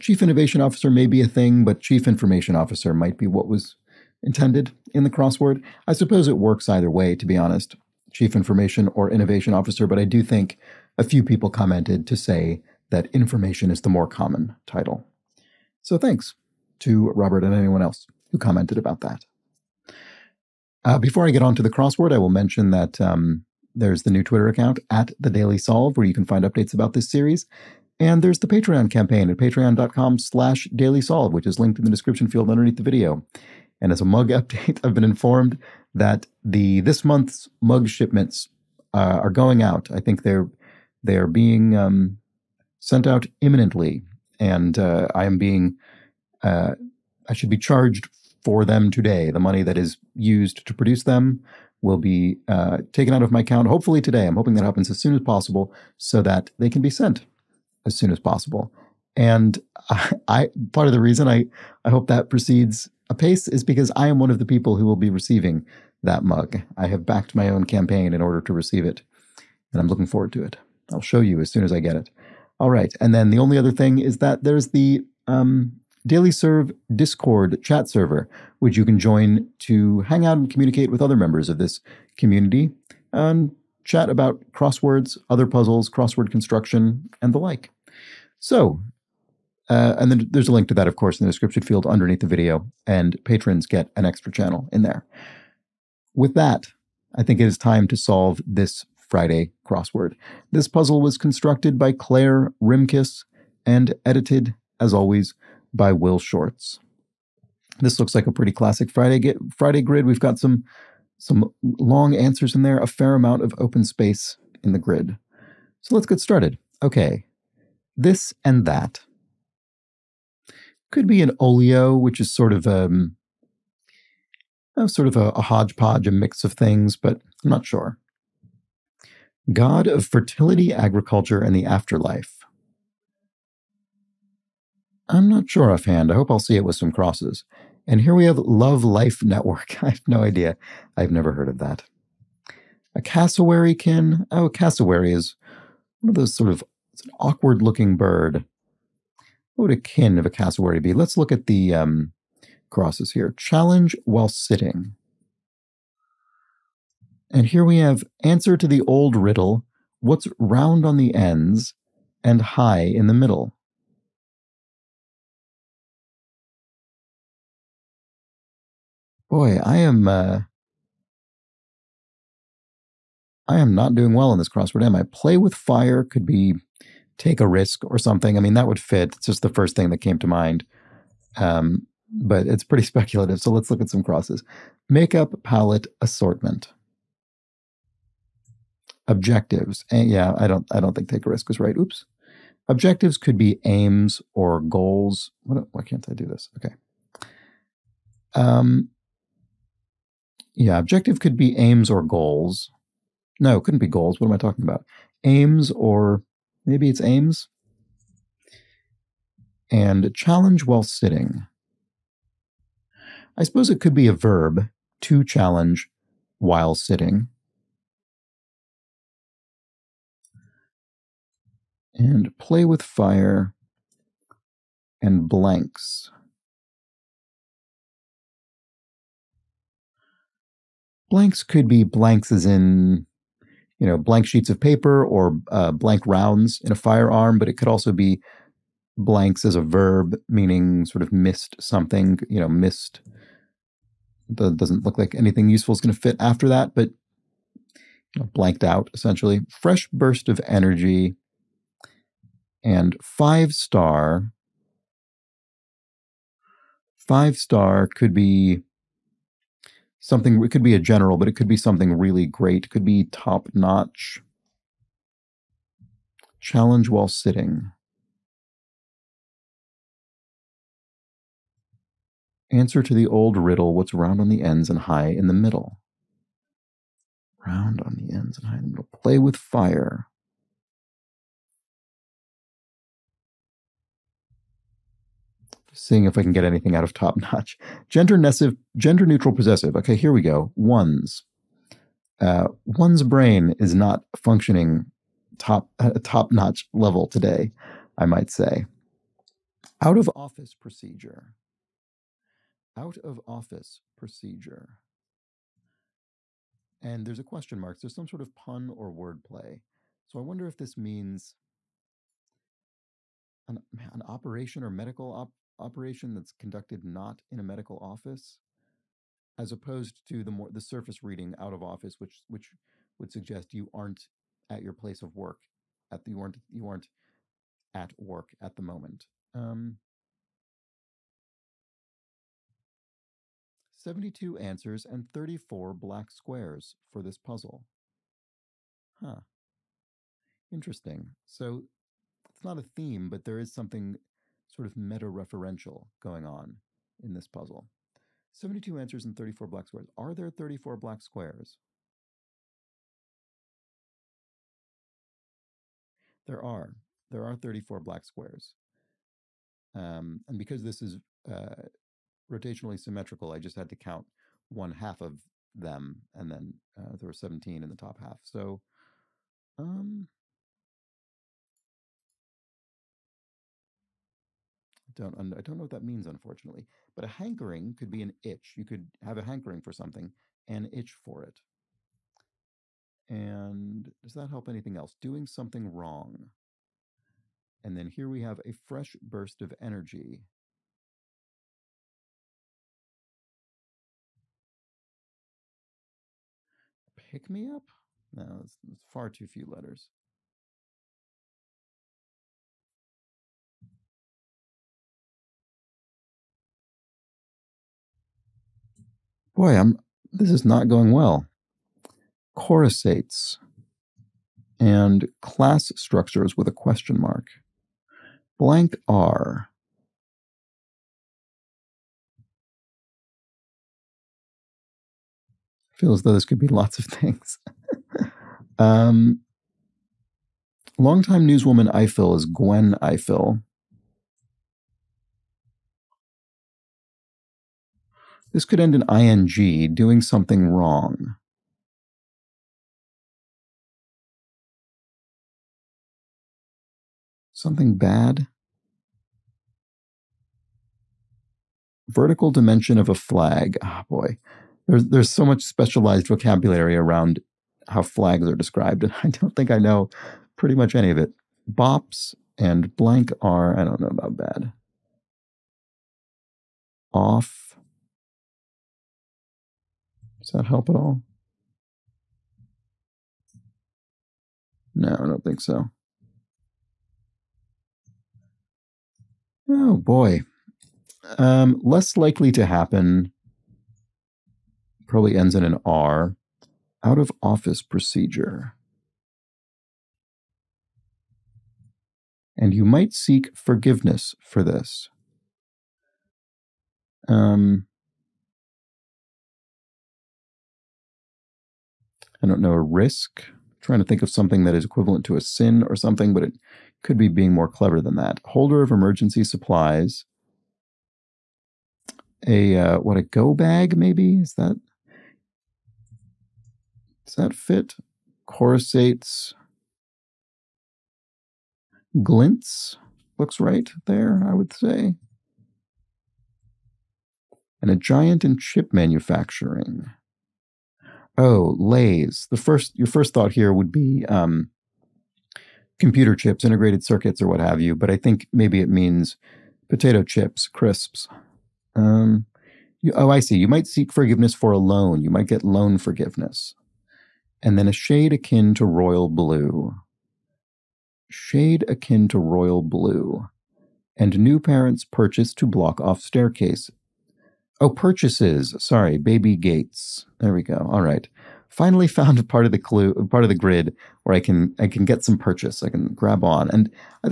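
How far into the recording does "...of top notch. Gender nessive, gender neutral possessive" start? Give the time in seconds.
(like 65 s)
286 s.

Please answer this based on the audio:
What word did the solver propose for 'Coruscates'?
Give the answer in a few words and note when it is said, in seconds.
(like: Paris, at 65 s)
Glints, at 522 s.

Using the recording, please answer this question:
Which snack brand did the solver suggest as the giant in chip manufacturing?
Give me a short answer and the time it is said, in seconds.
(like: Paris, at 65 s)
Lays, at 531 s.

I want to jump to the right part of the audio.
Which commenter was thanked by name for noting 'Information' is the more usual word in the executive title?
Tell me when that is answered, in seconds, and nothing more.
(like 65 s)
17 s.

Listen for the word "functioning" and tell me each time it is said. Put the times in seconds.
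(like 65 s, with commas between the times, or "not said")
294 s.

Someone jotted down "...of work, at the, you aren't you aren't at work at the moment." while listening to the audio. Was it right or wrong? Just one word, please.
right.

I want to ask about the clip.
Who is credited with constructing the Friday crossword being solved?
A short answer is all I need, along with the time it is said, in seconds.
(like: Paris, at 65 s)
Claire Rimkus, at 101 s.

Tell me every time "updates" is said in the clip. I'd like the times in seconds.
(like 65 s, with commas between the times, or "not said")
26 s, 34 s.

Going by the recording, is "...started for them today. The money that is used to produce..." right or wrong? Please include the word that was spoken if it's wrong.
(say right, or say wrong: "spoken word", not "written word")
wrong: "charged", not "started".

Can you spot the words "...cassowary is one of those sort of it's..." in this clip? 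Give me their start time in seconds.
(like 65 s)
144 s.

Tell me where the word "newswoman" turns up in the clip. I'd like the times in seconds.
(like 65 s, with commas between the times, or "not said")
431 s.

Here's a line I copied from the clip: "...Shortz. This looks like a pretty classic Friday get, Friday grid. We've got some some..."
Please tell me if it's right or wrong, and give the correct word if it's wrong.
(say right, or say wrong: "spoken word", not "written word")
right.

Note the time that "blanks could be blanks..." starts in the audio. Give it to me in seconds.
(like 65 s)
231 s.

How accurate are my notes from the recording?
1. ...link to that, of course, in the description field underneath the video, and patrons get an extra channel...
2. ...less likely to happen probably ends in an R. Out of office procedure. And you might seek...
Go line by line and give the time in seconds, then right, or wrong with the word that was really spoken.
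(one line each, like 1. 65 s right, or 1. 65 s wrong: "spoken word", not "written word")
1. 90 s right
2. 481 s right.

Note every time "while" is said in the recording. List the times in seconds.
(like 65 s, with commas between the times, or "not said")
154 s, 210 s, 216 s, 266 s.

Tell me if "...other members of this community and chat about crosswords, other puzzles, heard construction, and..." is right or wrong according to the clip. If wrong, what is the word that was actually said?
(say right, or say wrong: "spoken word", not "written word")
wrong: "crossword", not "heard".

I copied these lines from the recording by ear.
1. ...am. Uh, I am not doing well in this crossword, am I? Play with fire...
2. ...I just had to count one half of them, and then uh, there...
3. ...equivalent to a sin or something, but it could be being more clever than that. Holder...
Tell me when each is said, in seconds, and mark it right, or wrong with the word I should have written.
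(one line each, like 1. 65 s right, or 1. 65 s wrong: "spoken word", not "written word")
1. 169 s right
2. 363 s right
3. 504 s right.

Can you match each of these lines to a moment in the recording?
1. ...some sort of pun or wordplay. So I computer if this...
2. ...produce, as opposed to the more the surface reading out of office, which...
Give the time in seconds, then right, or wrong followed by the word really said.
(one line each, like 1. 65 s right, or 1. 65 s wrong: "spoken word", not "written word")
1. 307 s wrong: "wonder", not "computer"
2. 317 s wrong: "office", not "produce".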